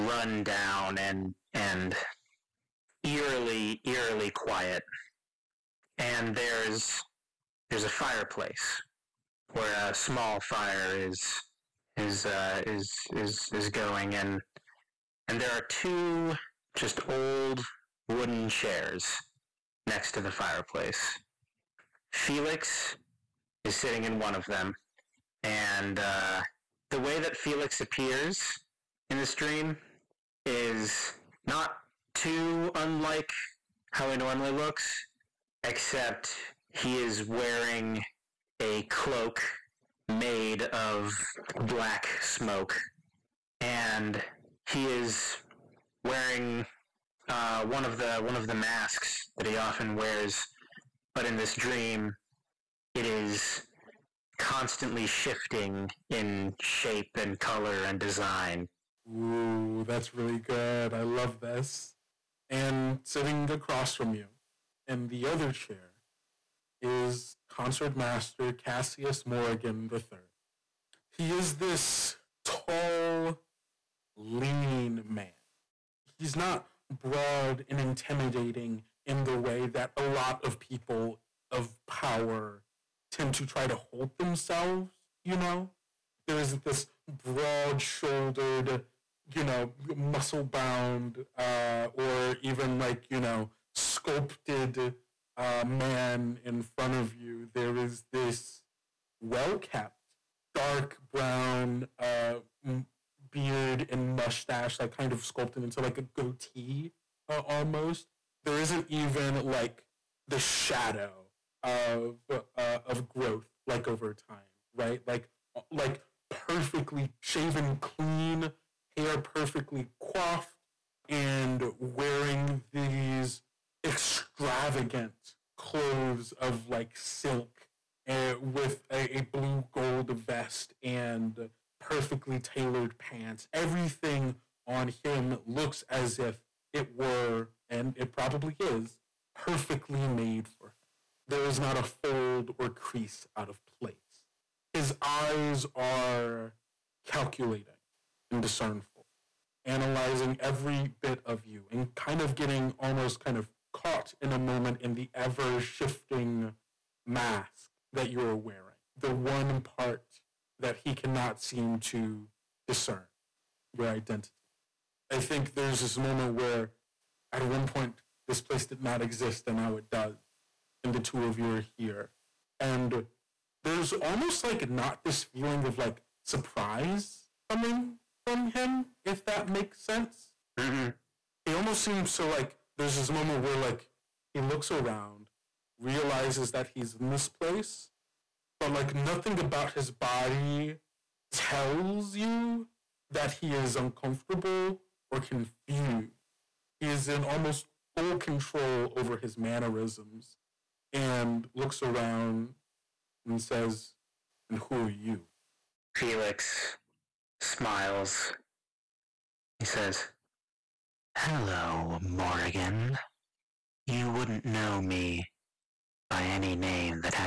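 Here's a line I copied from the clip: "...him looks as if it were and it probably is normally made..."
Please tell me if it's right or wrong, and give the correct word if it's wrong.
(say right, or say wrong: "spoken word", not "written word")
wrong: "perfectly", not "normally".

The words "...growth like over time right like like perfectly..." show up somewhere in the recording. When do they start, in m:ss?
1:53.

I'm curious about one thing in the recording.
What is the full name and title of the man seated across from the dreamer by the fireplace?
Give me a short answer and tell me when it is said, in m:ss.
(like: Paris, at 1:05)
Concertmaster Cassius Morrigan III, at 1:07.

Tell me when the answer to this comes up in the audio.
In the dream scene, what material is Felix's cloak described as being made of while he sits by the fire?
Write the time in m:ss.
0:41.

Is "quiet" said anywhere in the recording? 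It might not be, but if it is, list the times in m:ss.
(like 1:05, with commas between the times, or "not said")
0:04.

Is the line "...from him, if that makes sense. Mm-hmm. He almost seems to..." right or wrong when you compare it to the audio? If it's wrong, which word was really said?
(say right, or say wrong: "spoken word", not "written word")
right.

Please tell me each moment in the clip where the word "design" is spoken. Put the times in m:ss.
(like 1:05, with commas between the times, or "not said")
0:57.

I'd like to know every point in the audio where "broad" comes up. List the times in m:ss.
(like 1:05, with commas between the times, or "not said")
1:17, 1:27.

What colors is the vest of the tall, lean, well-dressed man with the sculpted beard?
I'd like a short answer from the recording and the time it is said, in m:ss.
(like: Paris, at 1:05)
Blue gold, at 2:09.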